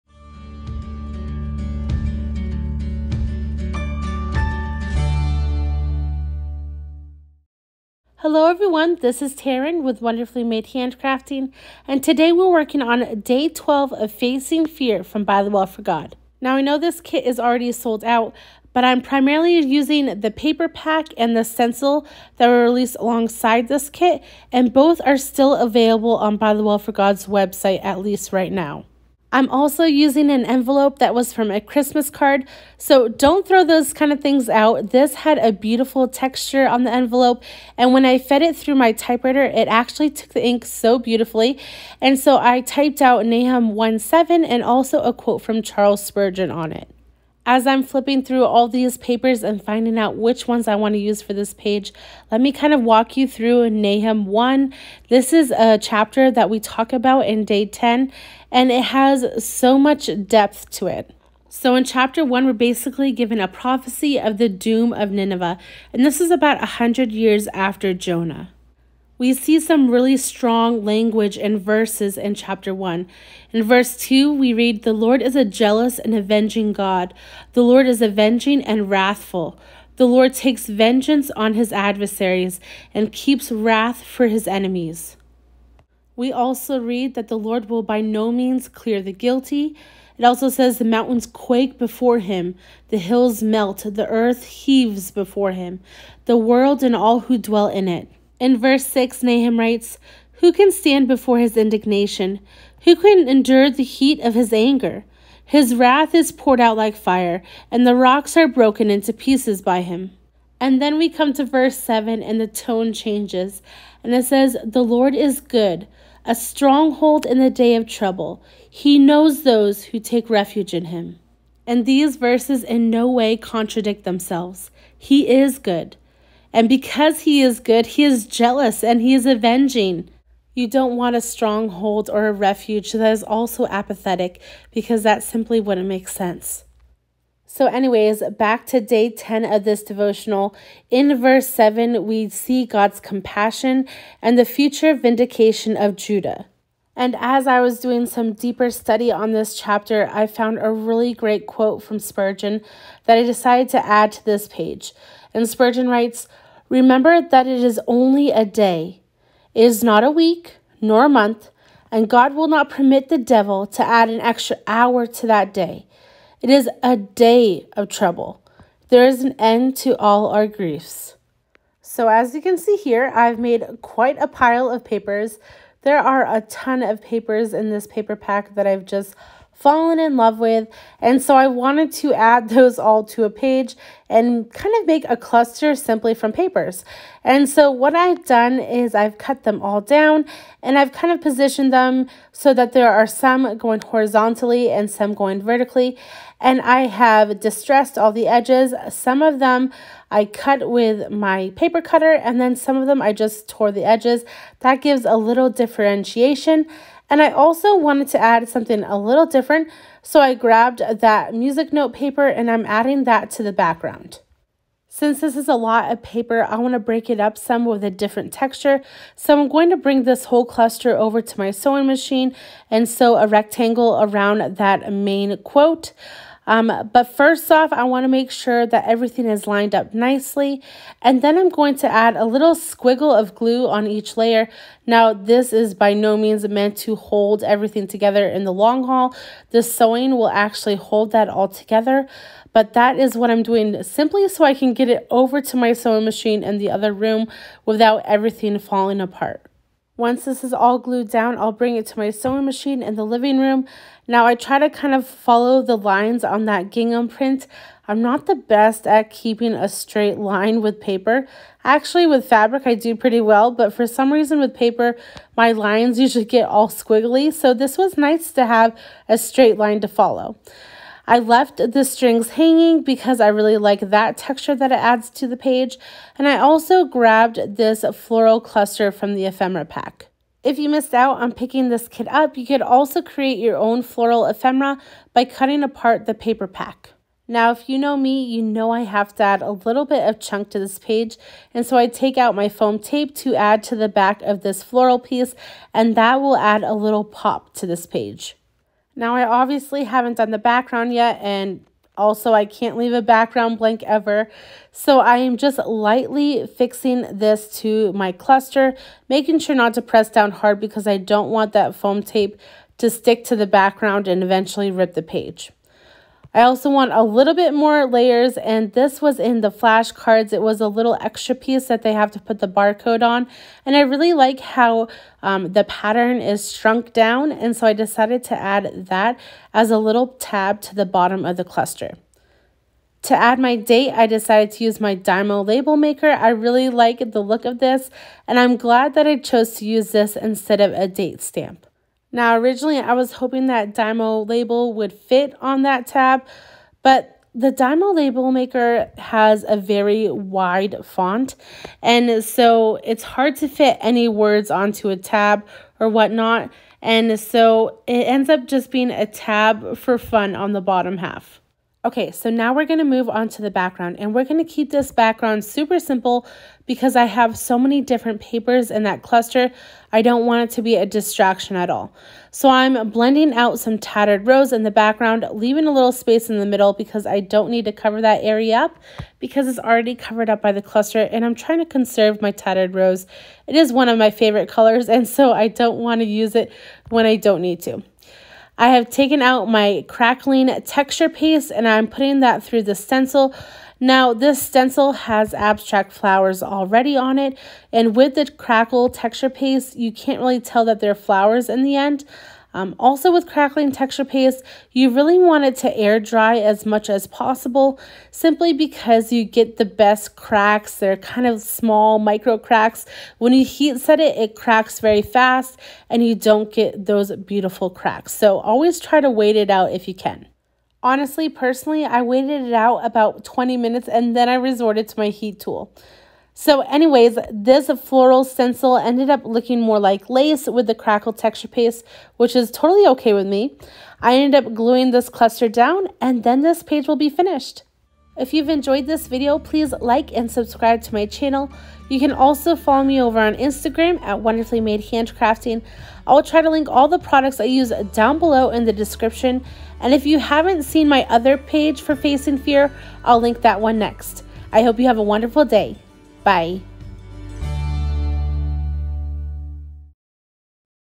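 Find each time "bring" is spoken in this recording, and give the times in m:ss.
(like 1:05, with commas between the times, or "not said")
3:39, 4:11.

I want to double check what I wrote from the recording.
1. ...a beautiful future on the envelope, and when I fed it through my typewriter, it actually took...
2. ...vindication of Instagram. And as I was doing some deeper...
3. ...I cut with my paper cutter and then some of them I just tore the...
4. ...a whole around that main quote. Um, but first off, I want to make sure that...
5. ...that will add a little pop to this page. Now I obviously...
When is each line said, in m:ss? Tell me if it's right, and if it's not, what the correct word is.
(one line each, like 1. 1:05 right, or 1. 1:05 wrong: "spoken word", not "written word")
1. 0:35 wrong: "texture", not "future"
2. 2:24 wrong: "Judah", not "Instagram"
3. 3:20 right
4. 3:43 wrong: "rectangle", not "whole"
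5. 4:55 right.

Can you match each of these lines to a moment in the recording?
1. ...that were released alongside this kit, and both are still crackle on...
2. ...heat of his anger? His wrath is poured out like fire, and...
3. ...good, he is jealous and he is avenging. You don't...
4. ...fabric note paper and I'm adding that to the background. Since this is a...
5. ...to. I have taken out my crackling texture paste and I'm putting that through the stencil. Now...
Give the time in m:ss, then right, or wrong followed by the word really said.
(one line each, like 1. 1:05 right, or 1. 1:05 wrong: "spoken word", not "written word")
1. 0:22 wrong: "available", not "crackle"
2. 1:43 right
3. 2:07 right
4. 3:31 wrong: "music", not "fabric"
5. 6:27 right.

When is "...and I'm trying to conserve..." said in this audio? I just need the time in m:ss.
6:21.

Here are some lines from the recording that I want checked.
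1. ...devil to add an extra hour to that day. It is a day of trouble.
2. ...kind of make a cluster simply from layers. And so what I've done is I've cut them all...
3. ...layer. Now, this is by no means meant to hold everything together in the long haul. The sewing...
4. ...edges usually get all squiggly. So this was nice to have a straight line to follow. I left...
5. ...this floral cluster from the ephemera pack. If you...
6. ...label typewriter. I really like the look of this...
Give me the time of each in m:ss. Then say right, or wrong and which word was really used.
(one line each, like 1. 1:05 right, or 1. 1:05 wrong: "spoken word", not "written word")
1. 2:43 right
2. 3:04 wrong: "papers", not "layers"
3. 3:54 right
4. 4:25 wrong: "lines", not "edges"
5. 4:37 right
6. 5:35 wrong: "maker", not "typewriter".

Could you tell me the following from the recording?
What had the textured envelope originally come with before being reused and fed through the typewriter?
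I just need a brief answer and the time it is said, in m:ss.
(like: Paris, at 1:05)
a Christmas card, at 0:31.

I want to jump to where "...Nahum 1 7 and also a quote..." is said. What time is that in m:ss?
0:43.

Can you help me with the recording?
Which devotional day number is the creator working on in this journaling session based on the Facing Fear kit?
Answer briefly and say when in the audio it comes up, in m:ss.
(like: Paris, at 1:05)
12, at 0:13.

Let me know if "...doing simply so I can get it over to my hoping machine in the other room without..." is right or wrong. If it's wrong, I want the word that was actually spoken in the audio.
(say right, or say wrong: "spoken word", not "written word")
wrong: "sewing", not "hoping".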